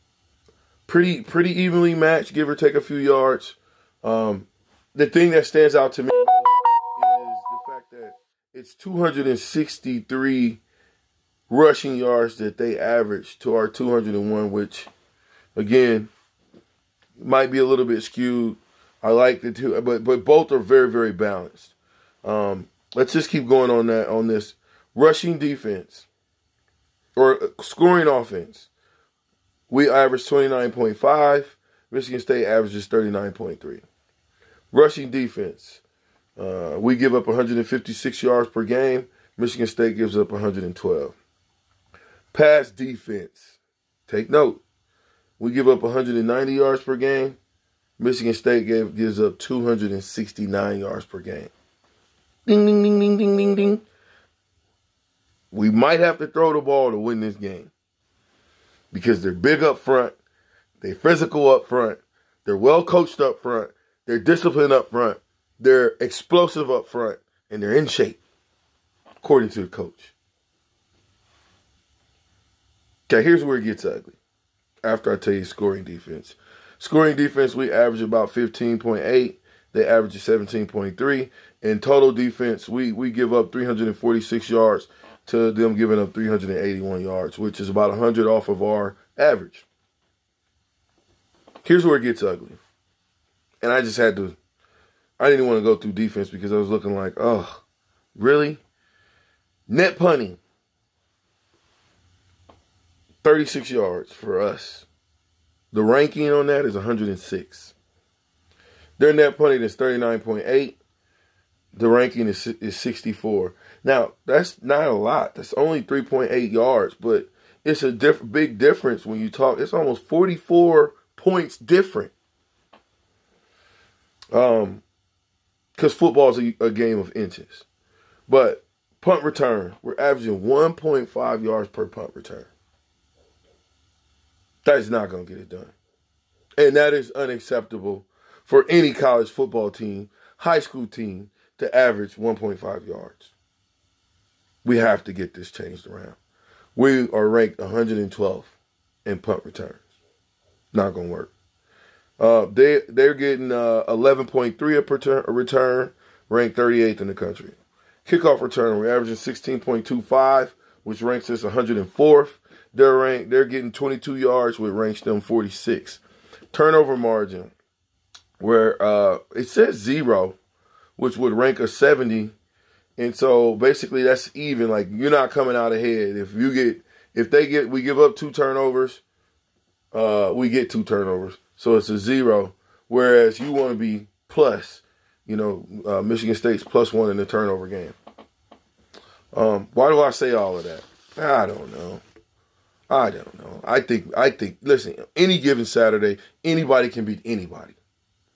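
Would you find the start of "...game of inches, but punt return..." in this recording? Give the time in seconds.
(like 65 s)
126 s.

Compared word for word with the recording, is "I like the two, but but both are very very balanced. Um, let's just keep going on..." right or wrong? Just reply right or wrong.
right.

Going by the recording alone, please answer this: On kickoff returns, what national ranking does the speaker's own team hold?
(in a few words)
104th.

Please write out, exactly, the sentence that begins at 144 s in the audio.
We have to get this changed around.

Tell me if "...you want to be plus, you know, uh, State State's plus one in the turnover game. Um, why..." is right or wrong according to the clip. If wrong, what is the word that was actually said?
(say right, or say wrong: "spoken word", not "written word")
wrong: "Michigan", not "State".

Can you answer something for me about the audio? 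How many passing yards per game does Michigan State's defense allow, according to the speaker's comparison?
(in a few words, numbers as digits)
269.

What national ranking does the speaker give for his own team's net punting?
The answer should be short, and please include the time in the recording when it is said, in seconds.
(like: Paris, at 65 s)
106, at 106 s.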